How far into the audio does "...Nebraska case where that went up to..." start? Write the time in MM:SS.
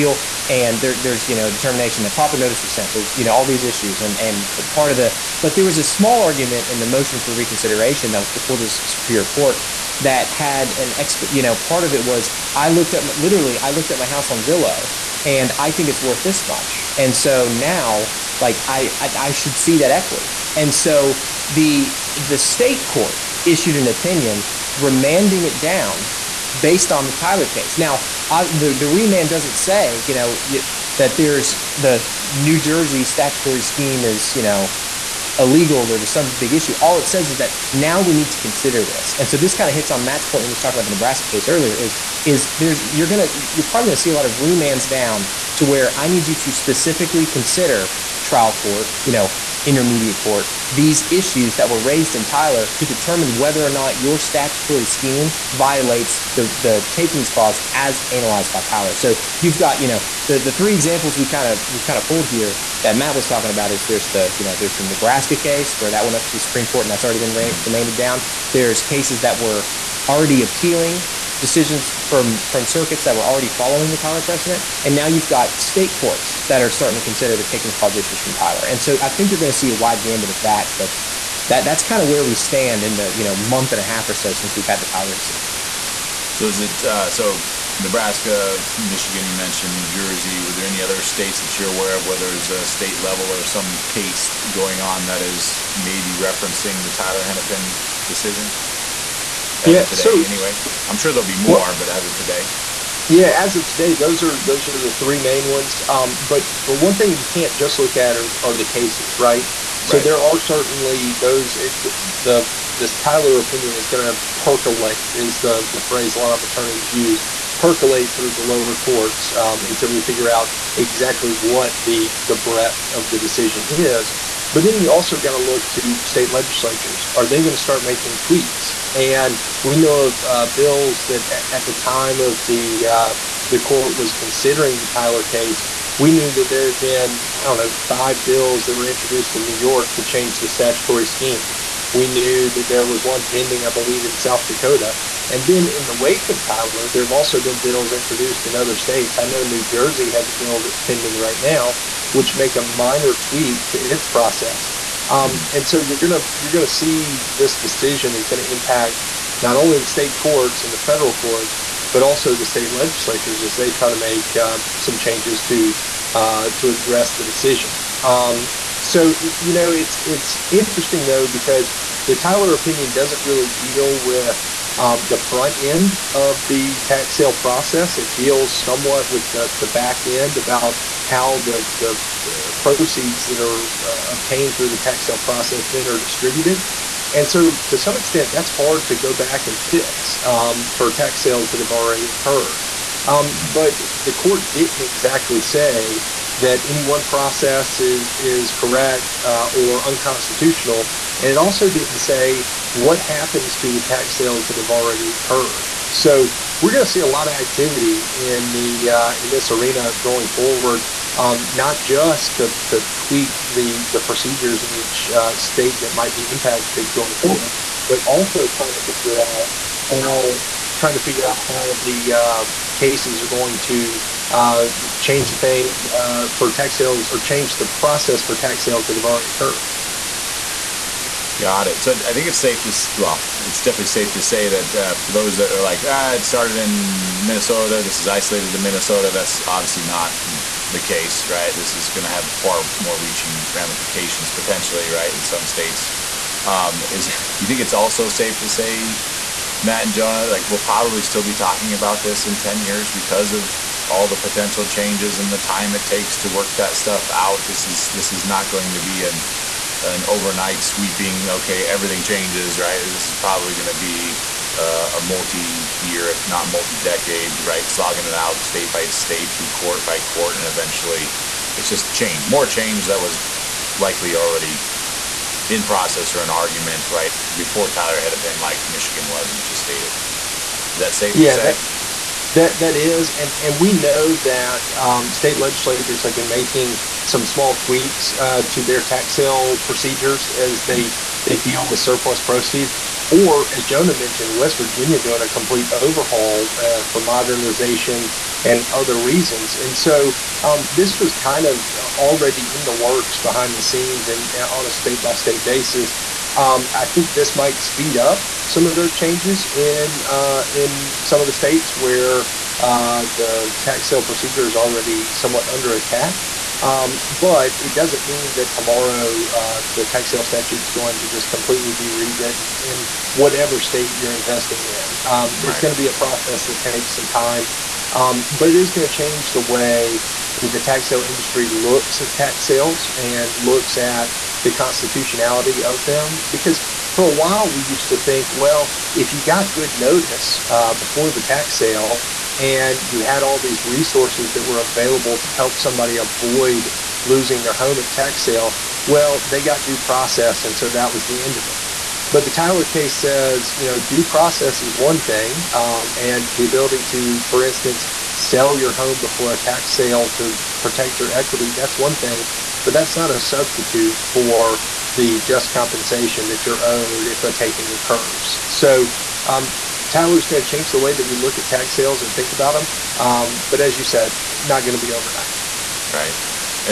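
01:04.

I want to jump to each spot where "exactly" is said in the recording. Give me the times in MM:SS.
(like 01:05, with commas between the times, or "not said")
02:00, 03:14.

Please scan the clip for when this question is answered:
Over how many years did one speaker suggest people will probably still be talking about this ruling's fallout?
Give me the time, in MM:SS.
04:12.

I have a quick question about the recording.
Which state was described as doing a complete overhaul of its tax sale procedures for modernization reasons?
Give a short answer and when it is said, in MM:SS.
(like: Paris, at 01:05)
West Virginia, at 04:54.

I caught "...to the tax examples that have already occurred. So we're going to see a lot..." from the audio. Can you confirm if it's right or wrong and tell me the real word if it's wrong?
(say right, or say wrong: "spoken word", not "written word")
wrong: "sales", not "examples".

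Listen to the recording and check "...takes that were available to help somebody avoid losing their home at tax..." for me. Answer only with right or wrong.
wrong.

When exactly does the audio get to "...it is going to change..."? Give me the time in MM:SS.
05:28.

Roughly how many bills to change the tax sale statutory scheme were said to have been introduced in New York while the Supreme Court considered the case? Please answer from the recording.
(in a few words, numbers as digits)
5.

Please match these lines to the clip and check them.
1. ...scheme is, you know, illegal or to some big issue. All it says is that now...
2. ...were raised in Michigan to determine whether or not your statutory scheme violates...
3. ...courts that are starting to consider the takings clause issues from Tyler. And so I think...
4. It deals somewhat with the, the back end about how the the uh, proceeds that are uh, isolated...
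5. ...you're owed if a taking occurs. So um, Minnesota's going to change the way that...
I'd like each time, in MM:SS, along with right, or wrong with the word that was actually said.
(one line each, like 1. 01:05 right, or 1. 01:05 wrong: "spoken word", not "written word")
1. 00:33 right
2. 00:51 wrong: "Tyler", not "Michigan"
3. 01:15 right
4. 02:57 wrong: "obtained", not "isolated"
5. 06:06 wrong: "Tyler", not "Minnesota".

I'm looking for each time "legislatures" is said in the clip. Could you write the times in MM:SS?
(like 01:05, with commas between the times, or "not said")
02:06, 02:42, 04:45.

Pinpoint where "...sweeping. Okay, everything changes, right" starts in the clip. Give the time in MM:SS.
04:20.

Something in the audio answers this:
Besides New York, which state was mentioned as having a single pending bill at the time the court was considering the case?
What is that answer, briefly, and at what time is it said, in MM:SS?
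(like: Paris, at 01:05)
South Dakota, at 02:24.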